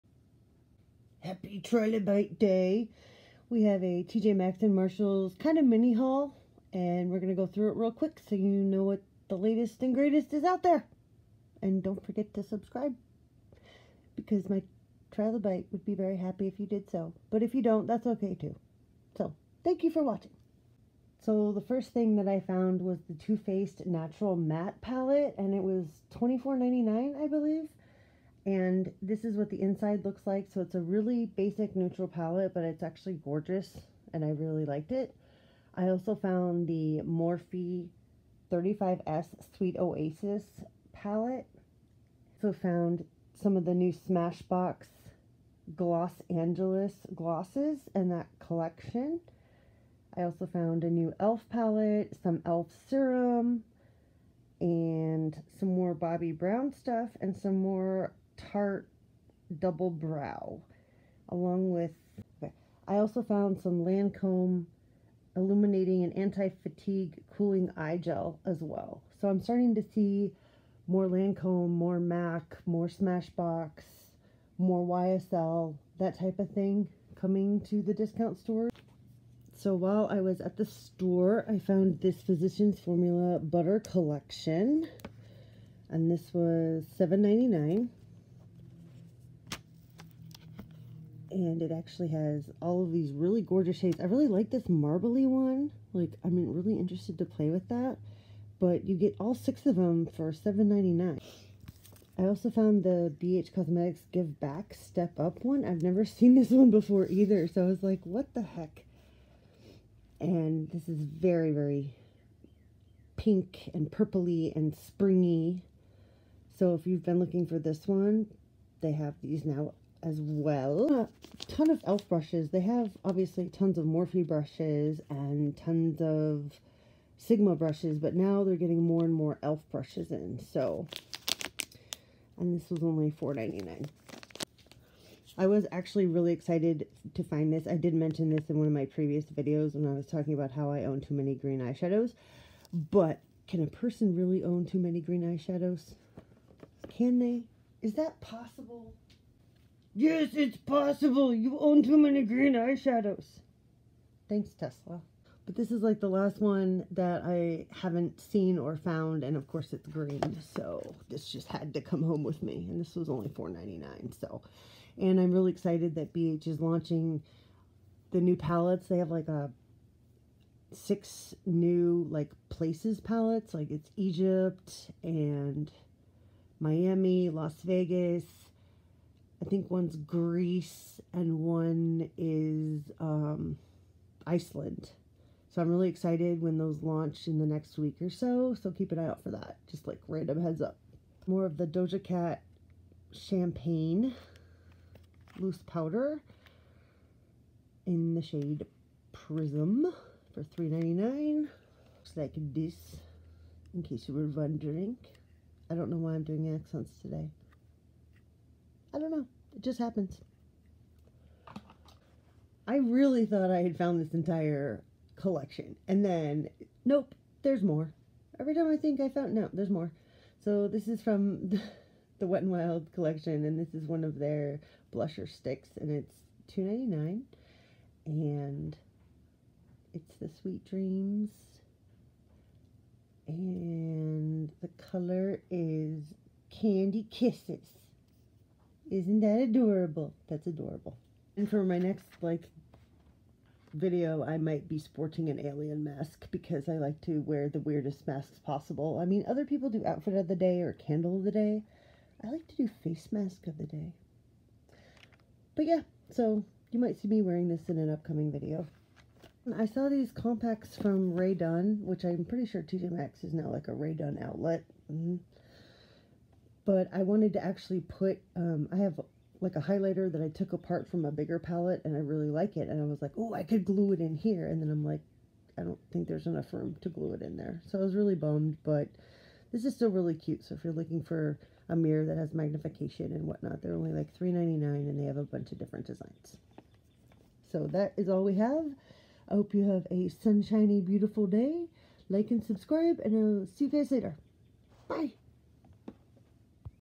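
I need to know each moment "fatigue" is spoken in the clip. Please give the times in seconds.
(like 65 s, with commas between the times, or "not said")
66 s.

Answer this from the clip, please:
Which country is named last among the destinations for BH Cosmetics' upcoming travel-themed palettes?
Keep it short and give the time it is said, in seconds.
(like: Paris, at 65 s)
Iceland, at 184 s.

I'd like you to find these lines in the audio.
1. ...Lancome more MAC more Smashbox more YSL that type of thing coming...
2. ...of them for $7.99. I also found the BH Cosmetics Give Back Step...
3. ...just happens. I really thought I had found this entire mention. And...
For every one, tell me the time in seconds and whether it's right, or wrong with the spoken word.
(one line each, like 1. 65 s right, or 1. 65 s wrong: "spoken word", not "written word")
1. 71 s right
2. 99 s right
3. 209 s wrong: "collection", not "mention".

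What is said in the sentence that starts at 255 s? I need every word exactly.
But yeah, so you might see me wearing this in an upcoming video.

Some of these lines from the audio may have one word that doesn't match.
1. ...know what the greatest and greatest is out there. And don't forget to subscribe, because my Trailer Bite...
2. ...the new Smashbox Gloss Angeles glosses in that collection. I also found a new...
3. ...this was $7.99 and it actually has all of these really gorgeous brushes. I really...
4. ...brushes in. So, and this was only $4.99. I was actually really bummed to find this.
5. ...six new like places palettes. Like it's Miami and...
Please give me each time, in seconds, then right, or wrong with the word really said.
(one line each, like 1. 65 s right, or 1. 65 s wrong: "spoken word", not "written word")
1. 8 s wrong: "latest", not "greatest"
2. 43 s right
3. 86 s wrong: "shades", not "brushes"
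4. 129 s wrong: "excited", not "bummed"
5. 170 s wrong: "Egypt", not "Miami".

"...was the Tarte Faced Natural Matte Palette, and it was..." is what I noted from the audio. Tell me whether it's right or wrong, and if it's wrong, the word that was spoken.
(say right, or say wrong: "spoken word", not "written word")
wrong: "Too", not "Tarte".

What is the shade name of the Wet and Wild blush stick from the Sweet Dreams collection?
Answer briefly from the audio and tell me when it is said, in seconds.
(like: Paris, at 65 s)
Candy Kisses, at 236 s.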